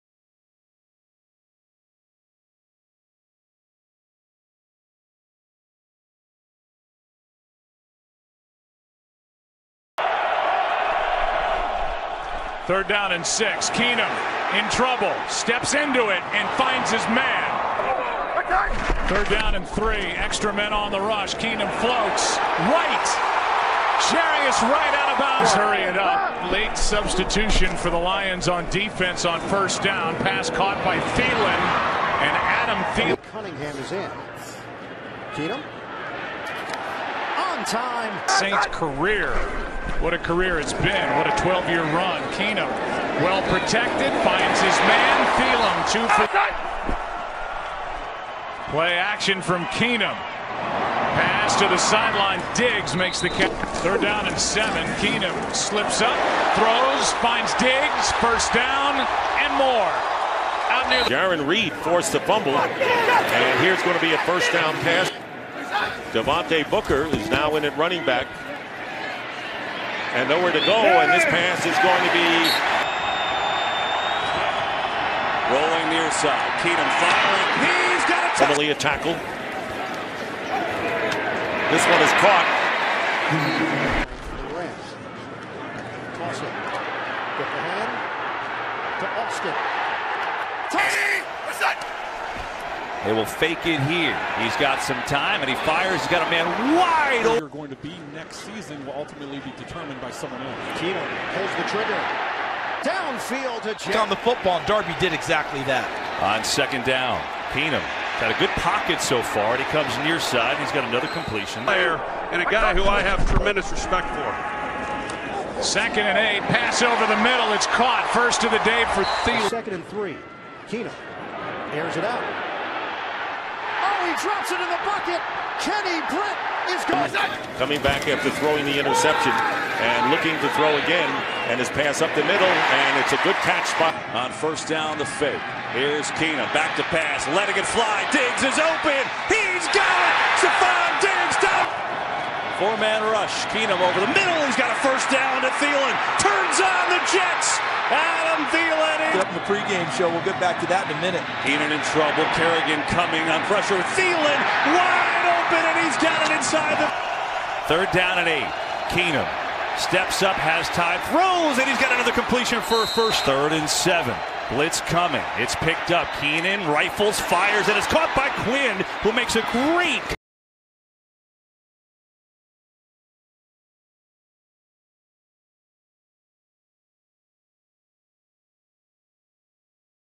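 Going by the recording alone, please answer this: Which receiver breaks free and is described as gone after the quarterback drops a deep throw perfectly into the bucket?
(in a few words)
Kenny Britt.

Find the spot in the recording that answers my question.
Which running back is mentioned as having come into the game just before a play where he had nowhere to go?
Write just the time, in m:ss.
1:06.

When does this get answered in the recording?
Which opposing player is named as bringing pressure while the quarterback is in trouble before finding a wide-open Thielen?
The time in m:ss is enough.
2:32.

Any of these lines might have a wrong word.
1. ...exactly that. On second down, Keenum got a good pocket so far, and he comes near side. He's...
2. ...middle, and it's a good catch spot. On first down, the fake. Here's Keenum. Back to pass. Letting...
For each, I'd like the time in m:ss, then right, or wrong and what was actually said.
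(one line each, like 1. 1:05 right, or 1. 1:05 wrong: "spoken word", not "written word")
1. 1:45 right
2. 2:12 right.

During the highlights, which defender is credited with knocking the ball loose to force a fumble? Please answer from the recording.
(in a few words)
Jarran Reed.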